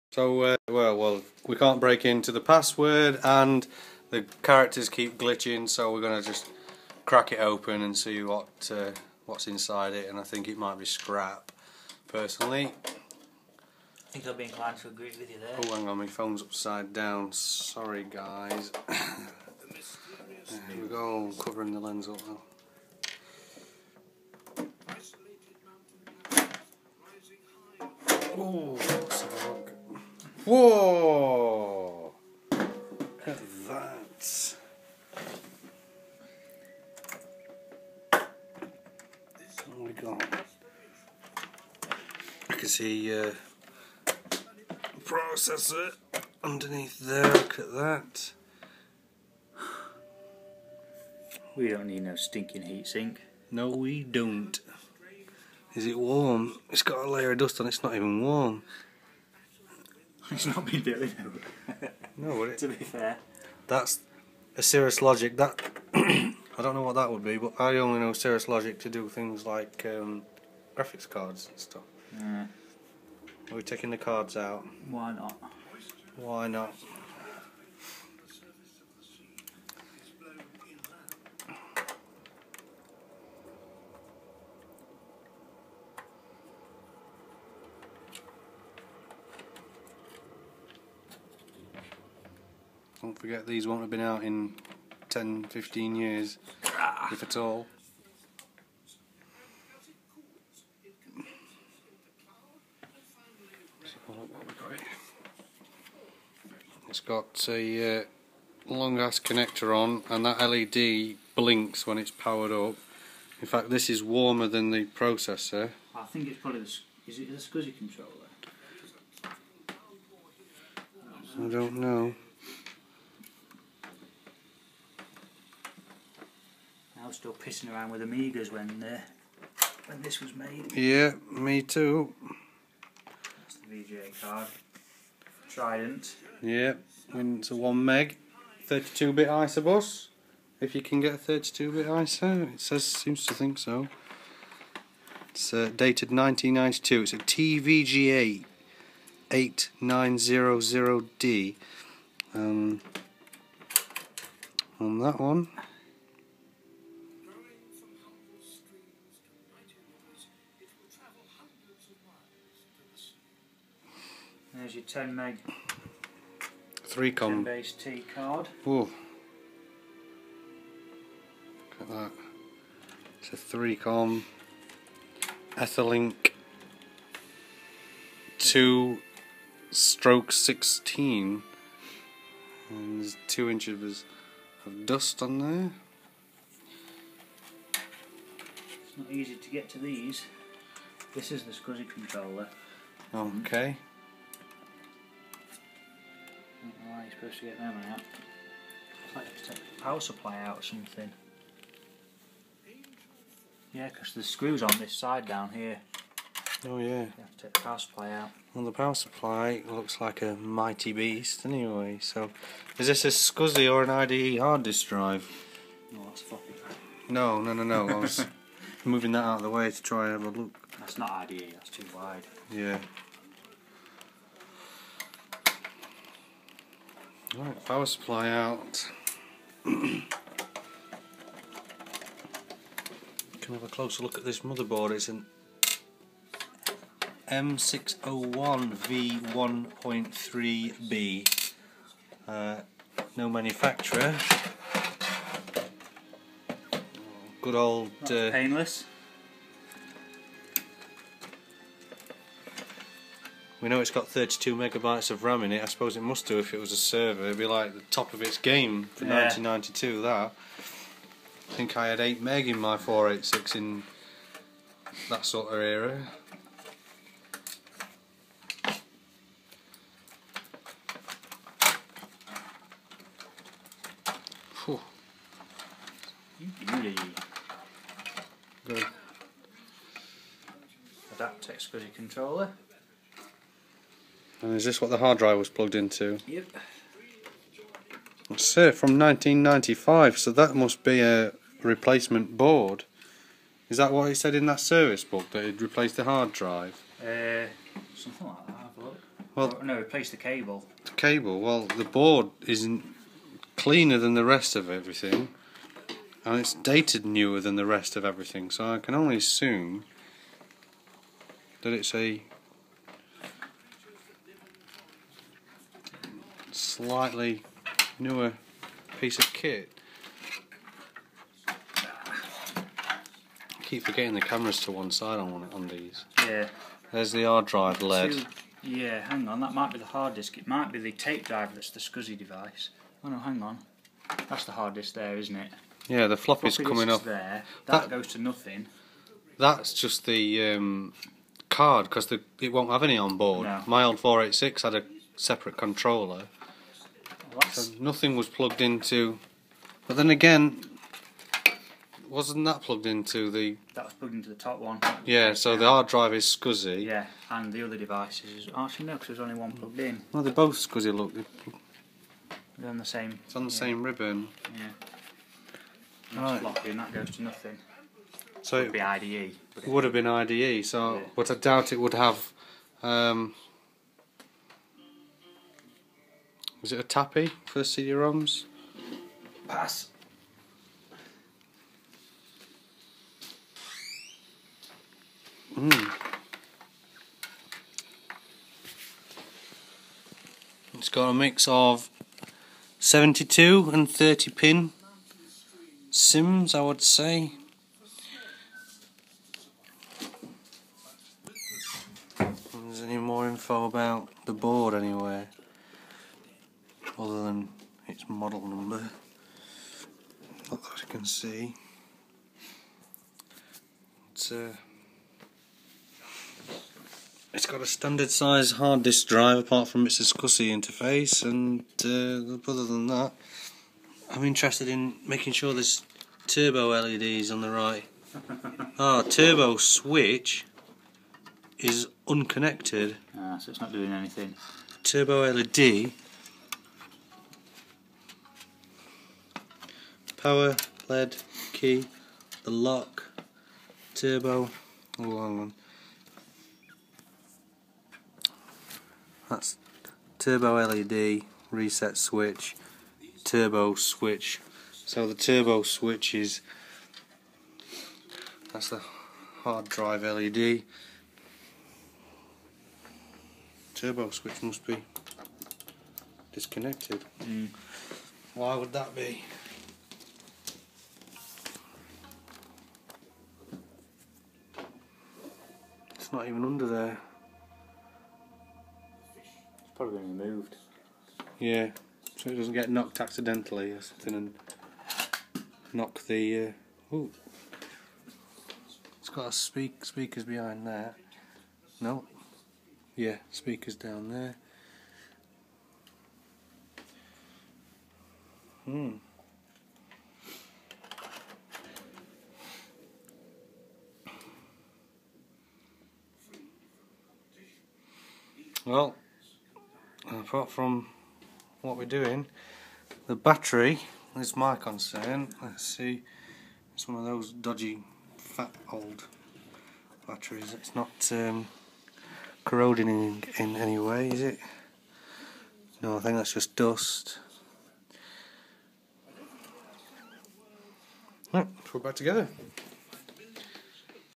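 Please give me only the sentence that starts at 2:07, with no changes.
was still pissing around with Amigas when uh, when this was made.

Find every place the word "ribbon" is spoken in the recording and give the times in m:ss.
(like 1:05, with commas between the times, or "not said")
6:03.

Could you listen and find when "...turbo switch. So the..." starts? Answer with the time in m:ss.
7:33.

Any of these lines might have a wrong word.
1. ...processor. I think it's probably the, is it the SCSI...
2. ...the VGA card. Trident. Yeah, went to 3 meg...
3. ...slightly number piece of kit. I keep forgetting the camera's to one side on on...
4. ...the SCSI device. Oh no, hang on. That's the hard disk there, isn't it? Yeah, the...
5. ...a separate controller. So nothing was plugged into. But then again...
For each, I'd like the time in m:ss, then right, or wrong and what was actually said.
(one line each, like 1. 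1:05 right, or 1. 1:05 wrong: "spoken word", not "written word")
1. 1:54 right
2. 2:13 wrong: "1", not "3"
3. 5:16 wrong: "newer", not "number"
4. 5:31 right
5. 5:44 right.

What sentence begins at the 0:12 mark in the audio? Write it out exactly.
I think I'll be inclined to agree with you there.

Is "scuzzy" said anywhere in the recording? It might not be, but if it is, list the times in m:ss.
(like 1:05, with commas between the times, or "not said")
5:56, 6:00.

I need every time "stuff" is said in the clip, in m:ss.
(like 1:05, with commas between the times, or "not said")
1:11.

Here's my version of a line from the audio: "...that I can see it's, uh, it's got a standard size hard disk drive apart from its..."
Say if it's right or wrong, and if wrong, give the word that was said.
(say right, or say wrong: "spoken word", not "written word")
right.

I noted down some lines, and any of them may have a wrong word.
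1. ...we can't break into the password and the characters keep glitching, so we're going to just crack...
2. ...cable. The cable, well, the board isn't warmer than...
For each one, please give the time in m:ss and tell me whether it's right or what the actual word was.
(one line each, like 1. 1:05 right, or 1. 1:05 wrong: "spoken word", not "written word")
1. 0:01 right
2. 5:00 wrong: "cleaner", not "warmer".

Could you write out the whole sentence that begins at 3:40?
That's not IDE, that's too wide.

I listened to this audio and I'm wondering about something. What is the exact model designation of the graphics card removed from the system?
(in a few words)
TVGA 8900D.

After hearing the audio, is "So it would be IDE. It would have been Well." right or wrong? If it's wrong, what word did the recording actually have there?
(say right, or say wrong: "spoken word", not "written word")
wrong: "IDE", not "Well".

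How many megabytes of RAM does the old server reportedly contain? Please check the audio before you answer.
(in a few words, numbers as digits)
32.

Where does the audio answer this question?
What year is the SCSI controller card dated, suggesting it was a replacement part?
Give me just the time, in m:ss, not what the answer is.
4:48.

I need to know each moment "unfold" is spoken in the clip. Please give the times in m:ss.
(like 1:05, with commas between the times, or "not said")
not said.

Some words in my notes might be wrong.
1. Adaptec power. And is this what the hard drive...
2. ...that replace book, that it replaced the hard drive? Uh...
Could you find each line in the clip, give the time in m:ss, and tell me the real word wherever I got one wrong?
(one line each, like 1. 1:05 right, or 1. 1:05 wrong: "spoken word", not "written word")
1. 4:41 wrong: "controller", not "power"
2. 4:54 wrong: "service", not "replace".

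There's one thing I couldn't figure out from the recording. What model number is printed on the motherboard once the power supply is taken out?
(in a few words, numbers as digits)
M601V1.3B.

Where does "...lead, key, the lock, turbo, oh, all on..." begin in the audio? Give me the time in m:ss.
7:20.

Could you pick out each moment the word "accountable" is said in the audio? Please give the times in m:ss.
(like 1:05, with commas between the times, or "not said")
not said.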